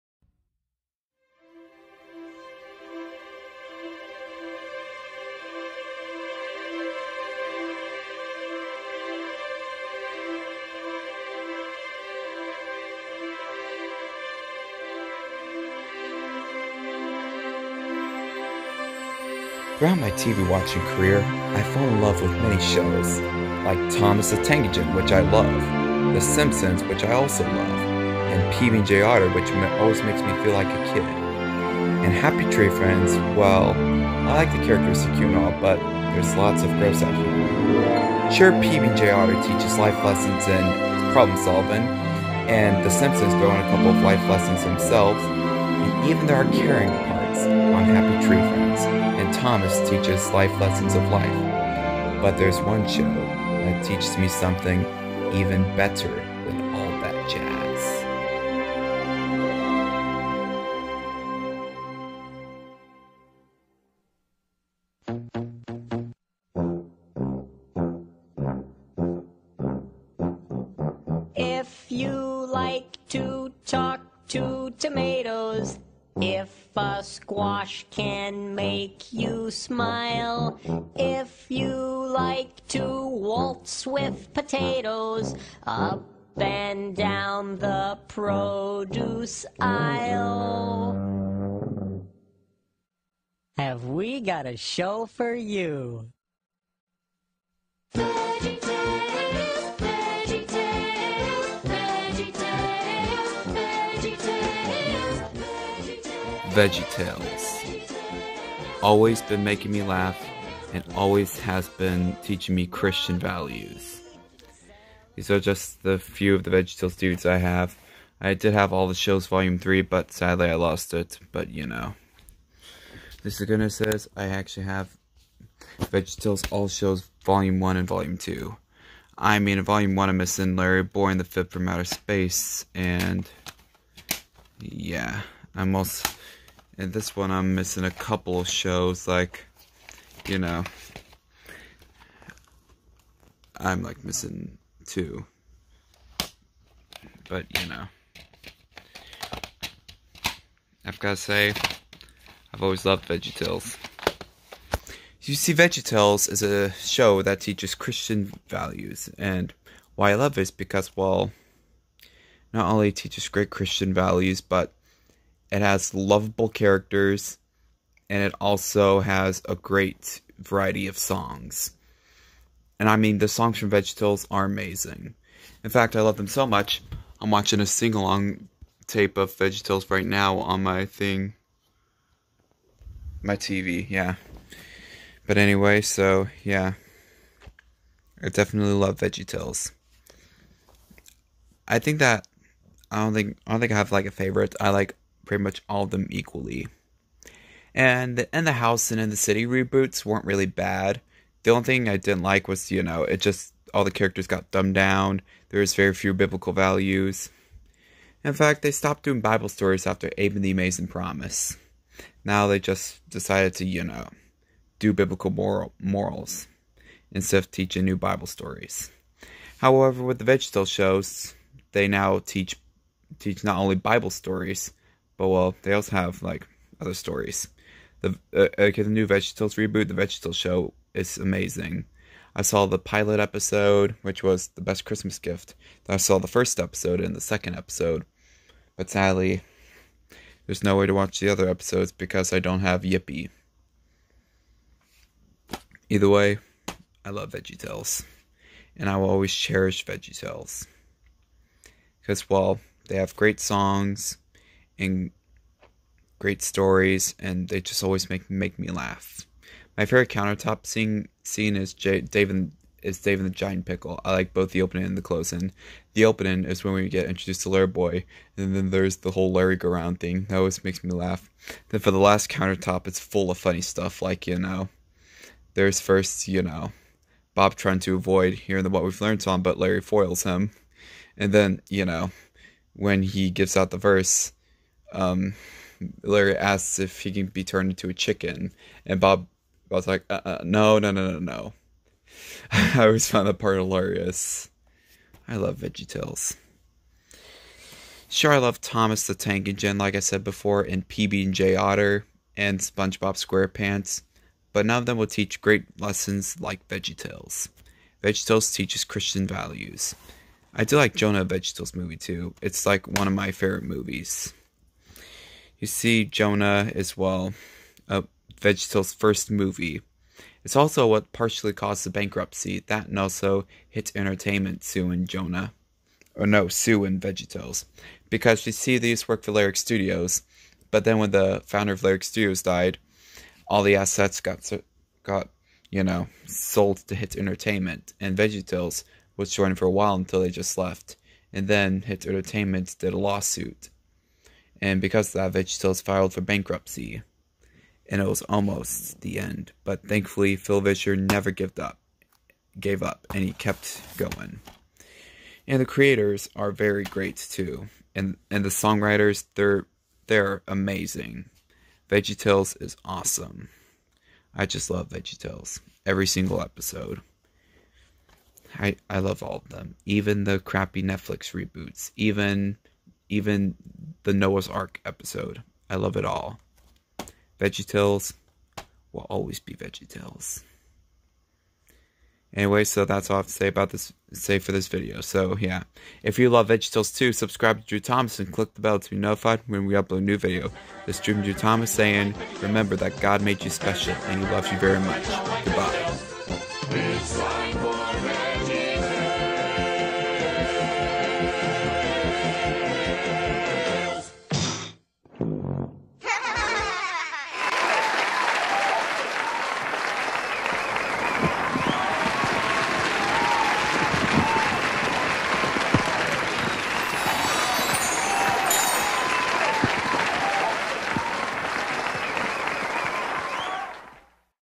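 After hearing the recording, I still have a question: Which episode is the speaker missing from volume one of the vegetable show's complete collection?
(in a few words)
Larry Boy and the Fib from Outer Space.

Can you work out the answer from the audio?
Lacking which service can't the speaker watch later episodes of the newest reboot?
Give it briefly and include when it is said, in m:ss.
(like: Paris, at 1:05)
Yippee, at 4:02.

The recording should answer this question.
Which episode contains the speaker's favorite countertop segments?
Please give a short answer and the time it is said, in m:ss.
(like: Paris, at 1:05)
Dave and the Giant Pickle, at 4:22.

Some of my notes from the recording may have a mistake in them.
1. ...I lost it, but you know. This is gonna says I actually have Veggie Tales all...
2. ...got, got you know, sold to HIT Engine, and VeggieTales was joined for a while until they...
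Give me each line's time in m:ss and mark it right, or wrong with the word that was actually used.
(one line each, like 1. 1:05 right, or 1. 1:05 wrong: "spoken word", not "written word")
1. 2:00 right
2. 5:34 wrong: "Entertainment", not "Engine".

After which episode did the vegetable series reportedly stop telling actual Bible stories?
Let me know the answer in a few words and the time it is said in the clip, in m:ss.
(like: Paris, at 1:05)
Abe and the Amazing Promise, at 3:30.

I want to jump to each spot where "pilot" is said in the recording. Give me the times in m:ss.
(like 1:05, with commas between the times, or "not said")
3:52.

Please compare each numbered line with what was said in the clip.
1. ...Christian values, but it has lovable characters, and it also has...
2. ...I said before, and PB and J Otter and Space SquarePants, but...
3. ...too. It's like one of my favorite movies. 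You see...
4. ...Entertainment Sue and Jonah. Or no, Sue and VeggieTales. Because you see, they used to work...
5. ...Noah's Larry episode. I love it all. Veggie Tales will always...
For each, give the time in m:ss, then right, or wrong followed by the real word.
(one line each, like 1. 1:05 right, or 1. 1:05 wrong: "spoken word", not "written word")
1. 2:43 right
2. 4:59 wrong: "SpongeBob", not "Space"
3. 5:11 right
4. 5:23 right
5. 6:14 wrong: "Ark", not "Larry".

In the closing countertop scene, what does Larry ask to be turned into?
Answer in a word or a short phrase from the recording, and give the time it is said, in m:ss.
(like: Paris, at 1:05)
A chicken, at 4:47.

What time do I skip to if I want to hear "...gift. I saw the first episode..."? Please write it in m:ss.
3:55.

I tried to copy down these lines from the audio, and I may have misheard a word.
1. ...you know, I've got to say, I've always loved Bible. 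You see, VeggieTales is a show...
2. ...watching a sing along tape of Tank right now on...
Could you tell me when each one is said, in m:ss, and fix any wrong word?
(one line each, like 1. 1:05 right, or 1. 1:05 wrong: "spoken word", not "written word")
1. 2:27 wrong: "VeggieTales", not "Bible"
2. 2:57 wrong: "VeggieTales", not "Tank".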